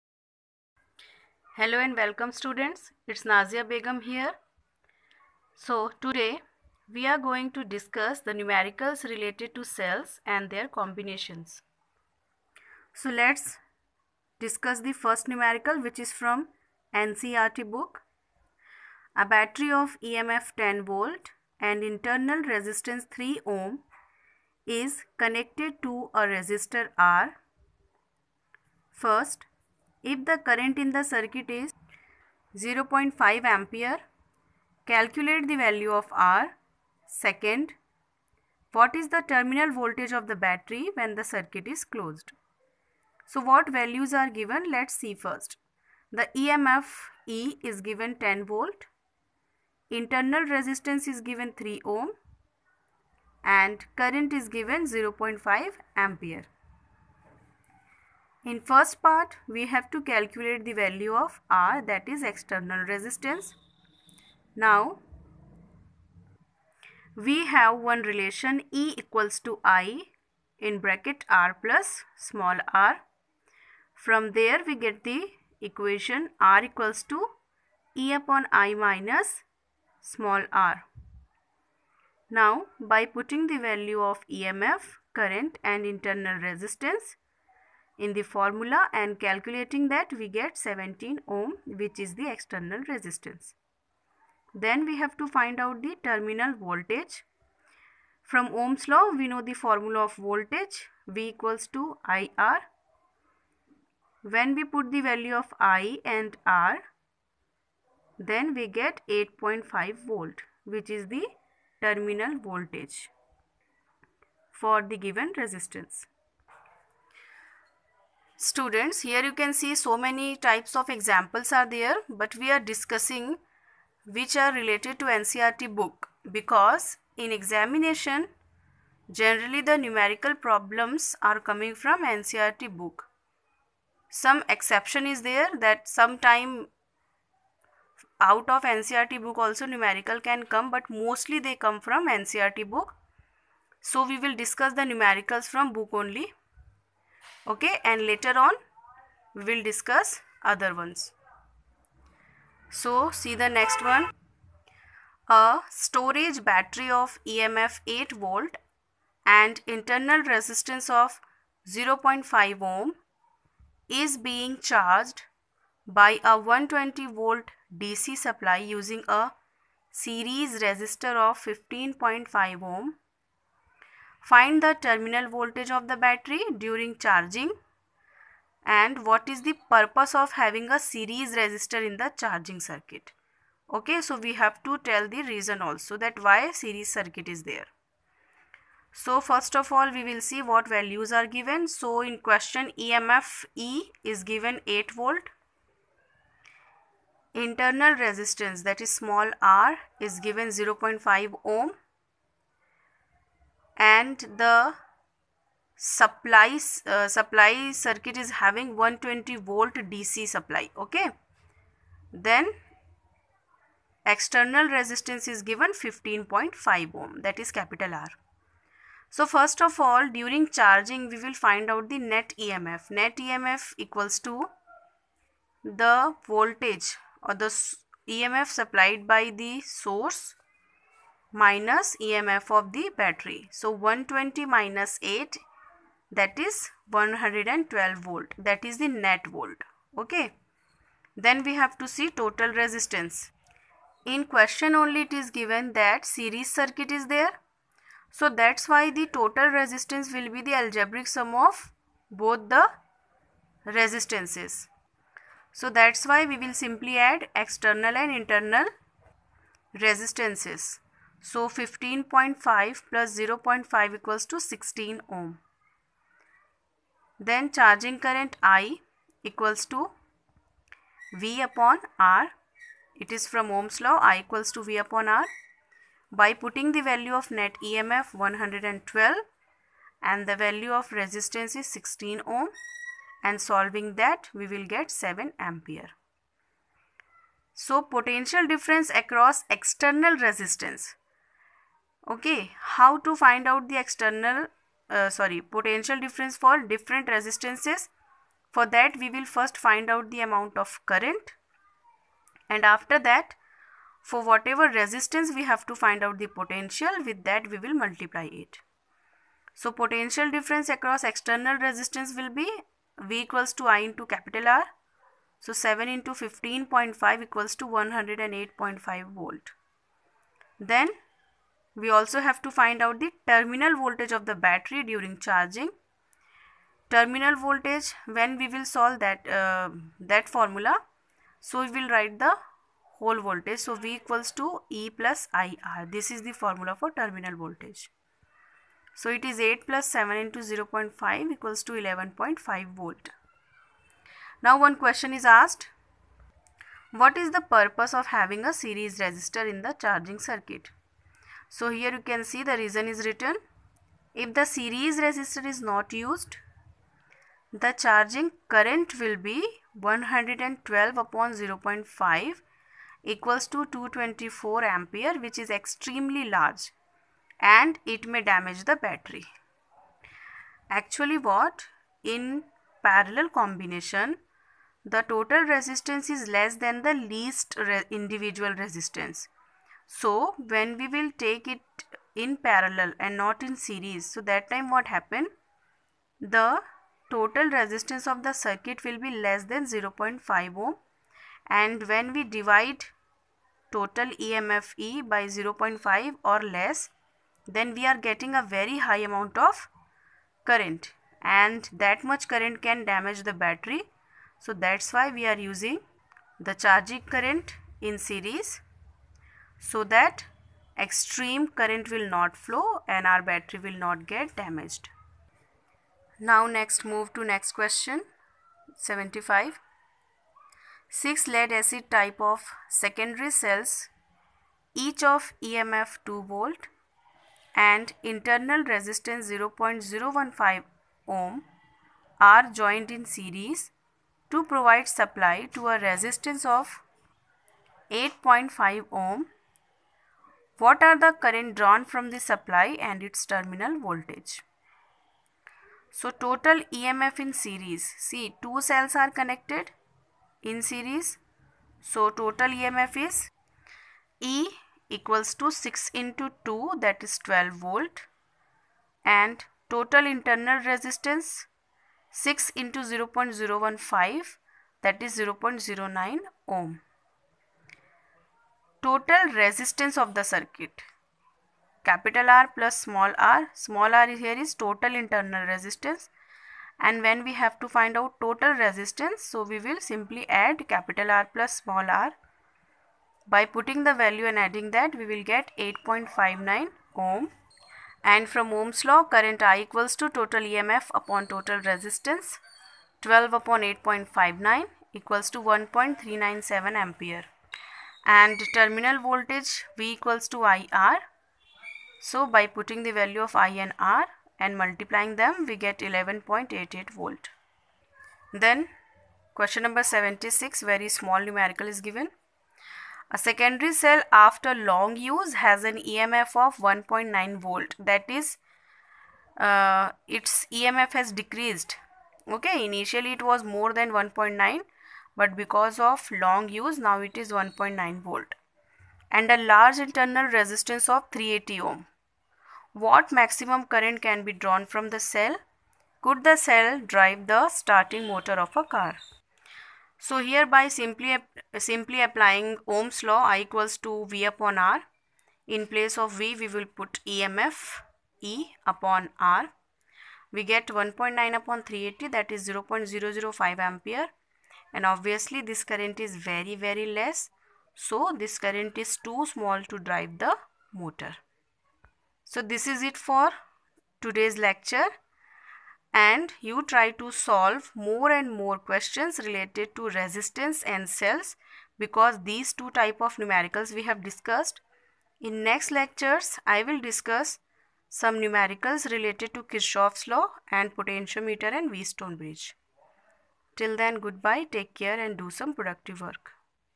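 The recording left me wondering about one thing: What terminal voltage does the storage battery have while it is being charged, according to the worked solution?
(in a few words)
11.5 volt.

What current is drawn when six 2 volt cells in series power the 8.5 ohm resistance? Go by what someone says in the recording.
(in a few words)
1.397 ampere.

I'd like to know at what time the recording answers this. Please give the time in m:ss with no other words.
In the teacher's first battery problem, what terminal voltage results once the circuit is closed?
1:49.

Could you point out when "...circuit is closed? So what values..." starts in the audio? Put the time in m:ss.
0:41.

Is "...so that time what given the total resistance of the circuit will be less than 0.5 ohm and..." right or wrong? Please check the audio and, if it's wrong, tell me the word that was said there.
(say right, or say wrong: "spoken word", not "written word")
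wrong: "happen", not "given".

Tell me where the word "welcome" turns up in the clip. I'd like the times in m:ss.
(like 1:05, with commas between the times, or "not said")
0:01.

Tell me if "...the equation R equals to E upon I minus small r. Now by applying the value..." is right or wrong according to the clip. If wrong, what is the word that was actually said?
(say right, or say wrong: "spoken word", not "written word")
wrong: "putting", not "applying".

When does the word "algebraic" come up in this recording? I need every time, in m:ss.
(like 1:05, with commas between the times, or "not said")
4:10.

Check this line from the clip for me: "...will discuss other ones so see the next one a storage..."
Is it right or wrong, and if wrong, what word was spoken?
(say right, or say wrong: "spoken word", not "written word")
right.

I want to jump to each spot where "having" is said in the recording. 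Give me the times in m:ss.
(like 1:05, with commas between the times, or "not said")
3:00, 3:28, 5:48.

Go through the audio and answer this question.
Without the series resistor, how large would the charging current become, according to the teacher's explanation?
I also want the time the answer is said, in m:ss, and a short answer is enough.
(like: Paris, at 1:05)
224 ampere, at 6:03.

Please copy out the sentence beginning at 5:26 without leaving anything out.
Terminal voltage when we will solve that, uh, that formula.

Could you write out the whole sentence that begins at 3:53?
So 120 minus 8 that is 112 volt that is the net volt.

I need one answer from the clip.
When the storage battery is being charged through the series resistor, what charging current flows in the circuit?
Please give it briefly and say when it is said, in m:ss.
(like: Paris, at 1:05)
7 ampere, at 4:44.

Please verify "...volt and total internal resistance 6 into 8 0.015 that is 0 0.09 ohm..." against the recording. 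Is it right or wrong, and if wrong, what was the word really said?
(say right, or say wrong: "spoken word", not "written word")
wrong: "0", not "8".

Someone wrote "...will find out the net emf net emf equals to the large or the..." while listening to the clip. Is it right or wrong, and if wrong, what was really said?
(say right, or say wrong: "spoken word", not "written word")
wrong: "voltage", not "large".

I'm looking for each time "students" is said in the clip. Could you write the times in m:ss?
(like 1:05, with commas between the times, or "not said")
0:02, 1:58.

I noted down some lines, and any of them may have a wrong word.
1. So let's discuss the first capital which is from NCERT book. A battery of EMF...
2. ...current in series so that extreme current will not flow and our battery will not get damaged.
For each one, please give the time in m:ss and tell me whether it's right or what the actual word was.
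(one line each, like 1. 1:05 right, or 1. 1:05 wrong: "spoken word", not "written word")
1. 0:12 wrong: "numerical", not "capital"
2. 6:47 right.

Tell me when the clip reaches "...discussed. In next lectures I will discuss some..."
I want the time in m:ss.
9:34.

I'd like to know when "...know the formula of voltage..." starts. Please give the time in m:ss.
1:39.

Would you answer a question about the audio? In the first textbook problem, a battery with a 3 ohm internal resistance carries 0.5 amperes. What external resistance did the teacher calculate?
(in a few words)
17 ohm.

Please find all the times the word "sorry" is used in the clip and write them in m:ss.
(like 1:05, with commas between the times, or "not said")
4:55.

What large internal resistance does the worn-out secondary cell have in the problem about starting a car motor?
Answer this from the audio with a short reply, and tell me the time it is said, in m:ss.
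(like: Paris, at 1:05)
380 ohm, at 8:51.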